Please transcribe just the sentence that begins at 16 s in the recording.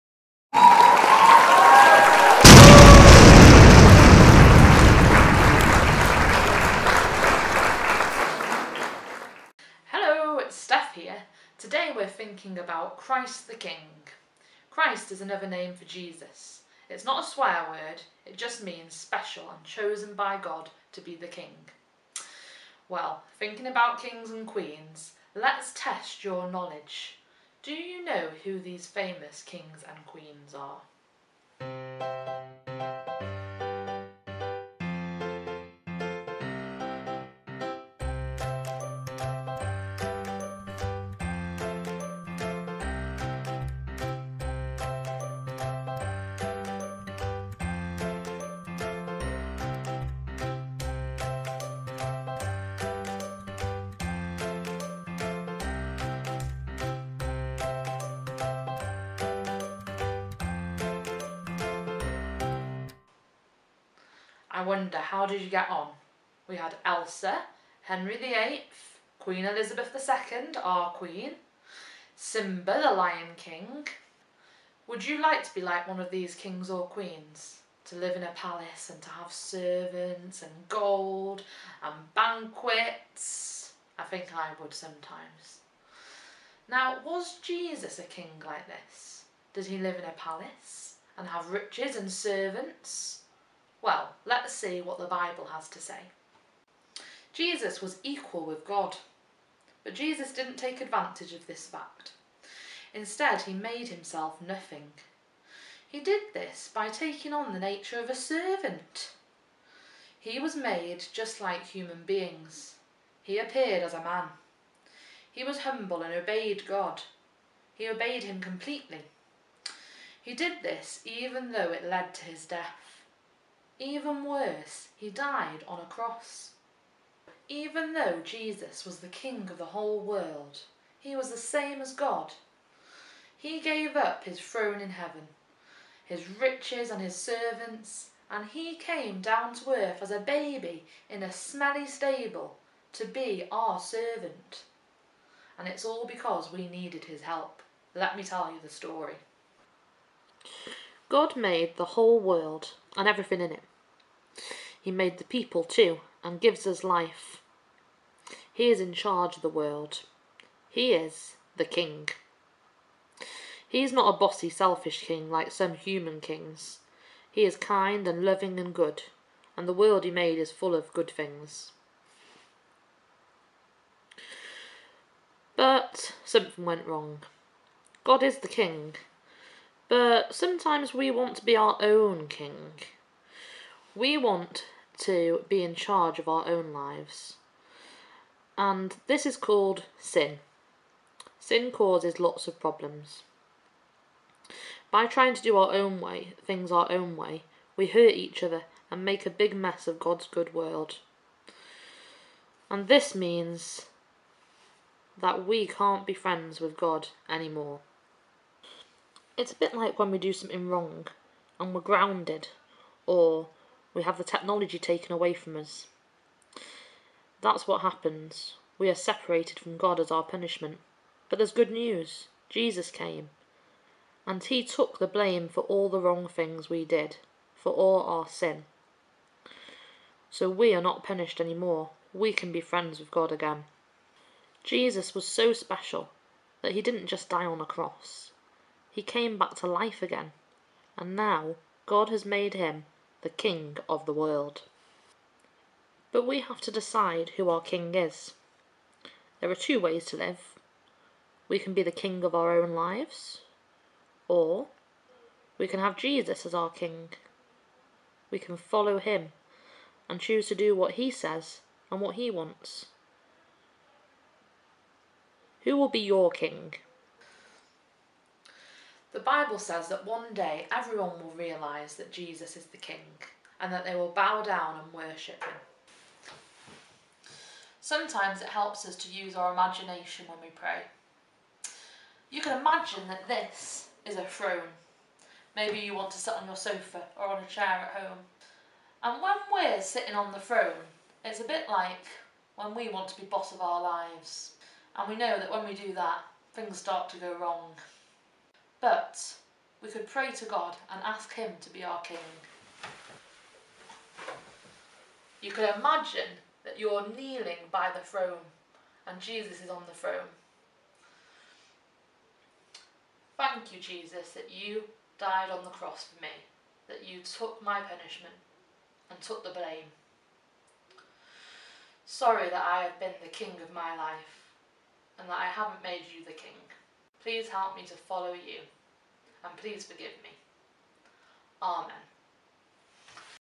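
It's not a swear word, it just means special and chosen by God to be the King.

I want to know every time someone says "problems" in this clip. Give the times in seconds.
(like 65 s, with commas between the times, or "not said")
192 s.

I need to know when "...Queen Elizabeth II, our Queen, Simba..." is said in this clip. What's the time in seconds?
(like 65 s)
69 s.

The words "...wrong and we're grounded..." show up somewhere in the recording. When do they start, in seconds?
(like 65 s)
210 s.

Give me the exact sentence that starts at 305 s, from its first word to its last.
You could imagine that you're kneeling by the throne and Jesus is on the throne.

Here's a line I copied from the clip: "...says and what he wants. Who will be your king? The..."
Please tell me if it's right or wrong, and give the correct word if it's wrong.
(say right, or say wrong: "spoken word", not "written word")
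right.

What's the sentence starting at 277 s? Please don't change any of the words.
Sometimes it helps us to use our imagination when we pray.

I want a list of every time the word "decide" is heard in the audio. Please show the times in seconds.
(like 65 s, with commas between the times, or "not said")
246 s.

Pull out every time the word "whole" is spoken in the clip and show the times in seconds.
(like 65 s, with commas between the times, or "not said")
129 s, 151 s.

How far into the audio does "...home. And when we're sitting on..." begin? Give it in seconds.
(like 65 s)
288 s.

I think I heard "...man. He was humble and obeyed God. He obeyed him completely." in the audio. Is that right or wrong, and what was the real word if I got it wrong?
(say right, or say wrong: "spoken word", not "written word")
right.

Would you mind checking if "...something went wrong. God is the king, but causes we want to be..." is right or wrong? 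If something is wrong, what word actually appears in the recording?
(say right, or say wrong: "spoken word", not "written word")
wrong: "sometimes", not "causes".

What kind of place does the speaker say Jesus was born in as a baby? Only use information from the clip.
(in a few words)
a smelly stable.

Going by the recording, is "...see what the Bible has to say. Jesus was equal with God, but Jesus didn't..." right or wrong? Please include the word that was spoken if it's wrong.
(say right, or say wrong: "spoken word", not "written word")
right.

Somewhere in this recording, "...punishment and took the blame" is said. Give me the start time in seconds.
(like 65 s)
317 s.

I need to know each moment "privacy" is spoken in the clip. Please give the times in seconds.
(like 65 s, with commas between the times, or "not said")
not said.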